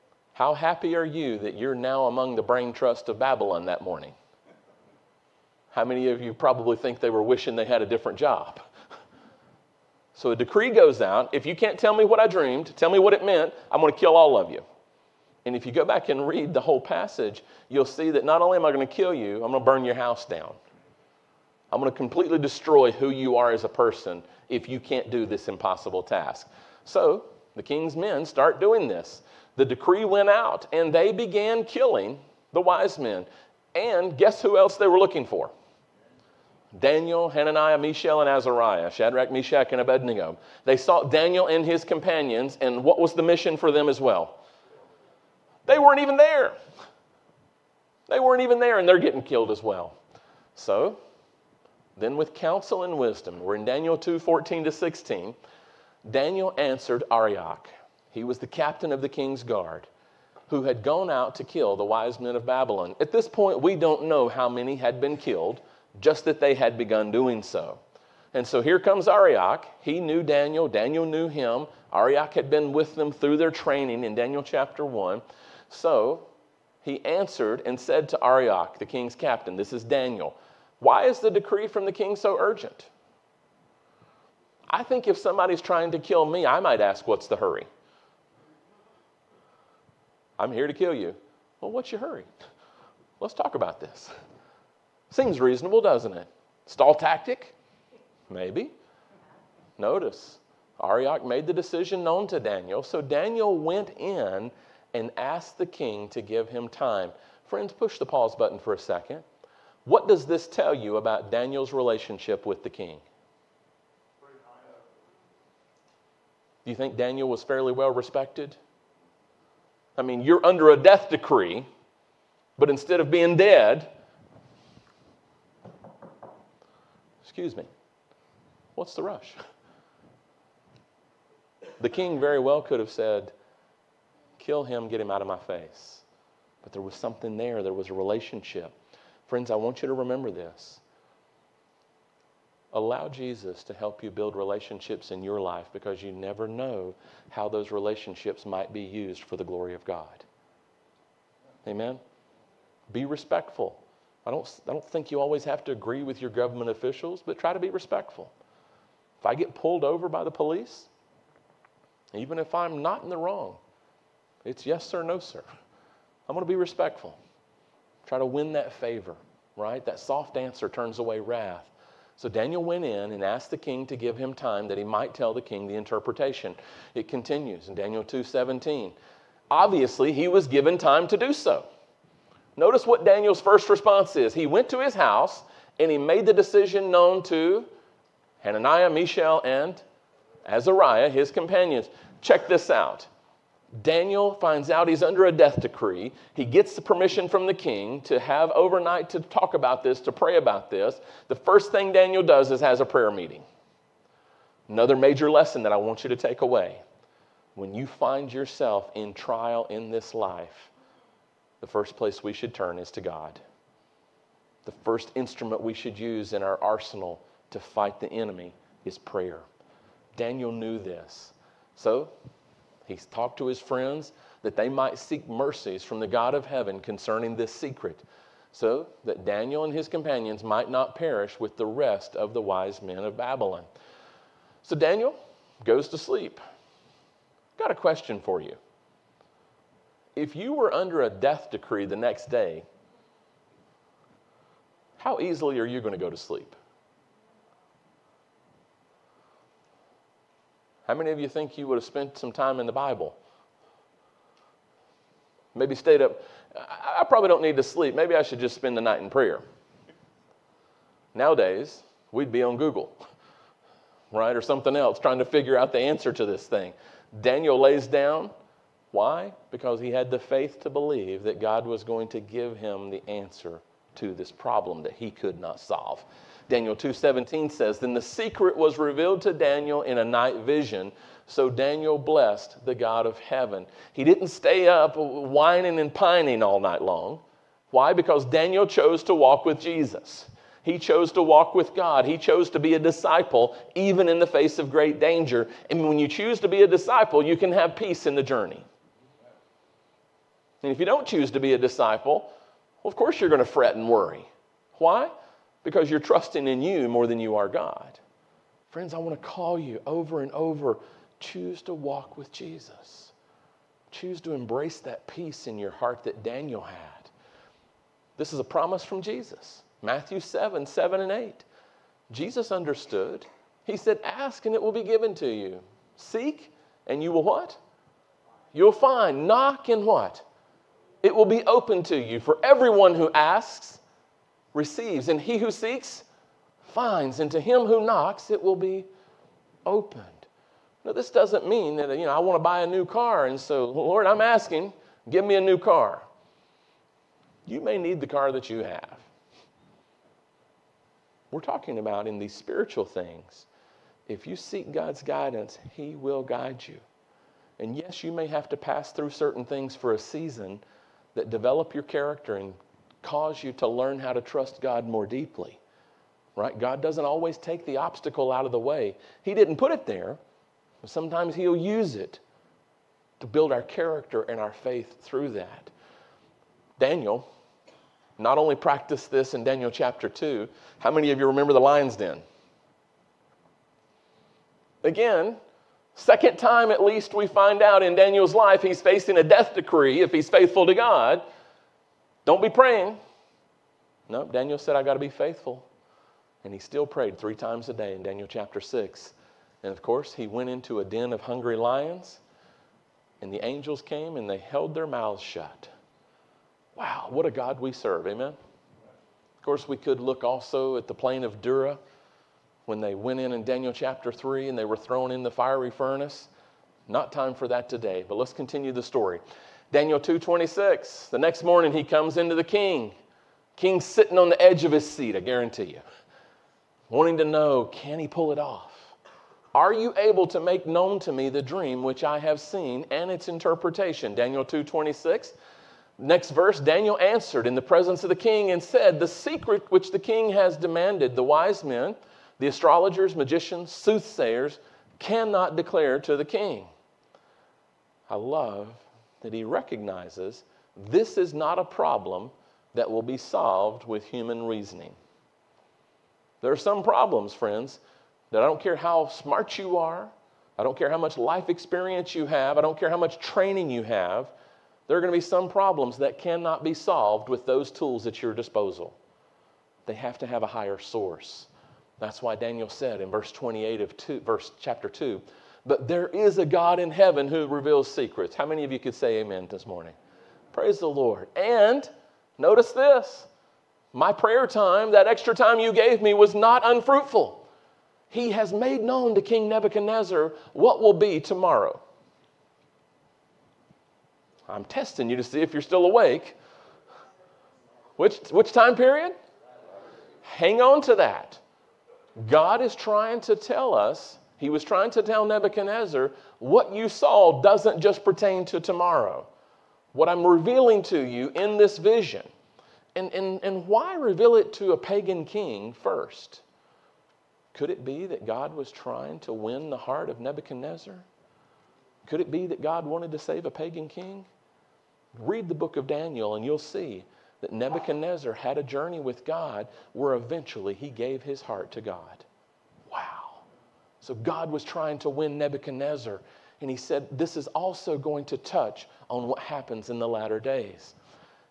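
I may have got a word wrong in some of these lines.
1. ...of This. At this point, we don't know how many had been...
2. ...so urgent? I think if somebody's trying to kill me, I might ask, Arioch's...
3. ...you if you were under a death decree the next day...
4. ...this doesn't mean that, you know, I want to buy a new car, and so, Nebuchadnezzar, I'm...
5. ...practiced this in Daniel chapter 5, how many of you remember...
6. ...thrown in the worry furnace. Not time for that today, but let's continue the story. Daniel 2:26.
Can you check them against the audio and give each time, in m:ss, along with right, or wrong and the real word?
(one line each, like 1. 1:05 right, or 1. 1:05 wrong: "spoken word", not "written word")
1. 1:02 wrong: "Babylon", not "This"
2. 1:22 wrong: "What", not "Arioch"
3. 3:58 right
4. 5:40 wrong: "Lord", not "Nebuchadnezzar"
5. 6:18 wrong: "2", not "5"
6. 6:54 wrong: "fiery", not "worry".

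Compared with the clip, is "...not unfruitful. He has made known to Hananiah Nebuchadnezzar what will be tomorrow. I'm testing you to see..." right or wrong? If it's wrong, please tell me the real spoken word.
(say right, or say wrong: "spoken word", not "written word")
wrong: "King", not "Hananiah".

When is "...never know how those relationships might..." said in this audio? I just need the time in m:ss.
2:26.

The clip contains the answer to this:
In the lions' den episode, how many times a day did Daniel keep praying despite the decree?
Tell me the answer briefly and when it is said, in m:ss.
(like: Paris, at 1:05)
3, at 6:37.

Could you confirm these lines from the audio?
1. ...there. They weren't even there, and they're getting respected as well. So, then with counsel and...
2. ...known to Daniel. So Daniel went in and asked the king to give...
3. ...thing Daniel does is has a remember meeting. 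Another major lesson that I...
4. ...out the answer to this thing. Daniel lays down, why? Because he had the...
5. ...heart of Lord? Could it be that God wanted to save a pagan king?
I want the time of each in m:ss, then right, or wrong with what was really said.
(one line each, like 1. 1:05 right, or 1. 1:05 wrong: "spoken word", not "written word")
1. 0:46 wrong: "killed", not "respected"
2. 1:42 right
3. 3:21 wrong: "prayer", not "remember"
4. 4:25 right
5. 8:39 wrong: "Nebuchadnezzar", not "Lord".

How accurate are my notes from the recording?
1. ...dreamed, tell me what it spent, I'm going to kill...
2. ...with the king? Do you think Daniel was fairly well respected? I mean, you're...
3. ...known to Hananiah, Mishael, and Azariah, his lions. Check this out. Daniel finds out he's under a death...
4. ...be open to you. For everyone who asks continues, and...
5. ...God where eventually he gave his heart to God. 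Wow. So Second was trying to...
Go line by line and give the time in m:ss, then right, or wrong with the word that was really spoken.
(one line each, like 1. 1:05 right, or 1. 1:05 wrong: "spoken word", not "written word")
1. 0:12 wrong: "meant", not "spent"
2. 1:52 right
3. 3:06 wrong: "companions", not "lions"
4. 5:31 wrong: "receives", not "continues"
5. 8:49 wrong: "God", not "Second".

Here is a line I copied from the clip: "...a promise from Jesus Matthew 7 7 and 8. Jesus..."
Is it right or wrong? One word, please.
right.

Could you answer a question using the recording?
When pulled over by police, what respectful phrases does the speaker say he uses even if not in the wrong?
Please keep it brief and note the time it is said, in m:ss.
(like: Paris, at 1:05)
yes, sir, no, sir, at 2:44.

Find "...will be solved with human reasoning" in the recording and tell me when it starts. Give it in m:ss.
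7:32.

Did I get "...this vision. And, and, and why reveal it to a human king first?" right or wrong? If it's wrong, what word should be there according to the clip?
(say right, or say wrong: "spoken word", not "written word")
wrong: "pagan", not "human".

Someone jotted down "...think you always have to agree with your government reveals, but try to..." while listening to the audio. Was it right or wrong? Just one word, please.
wrong.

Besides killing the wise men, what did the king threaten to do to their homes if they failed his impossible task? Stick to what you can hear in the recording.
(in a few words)
burn your house down.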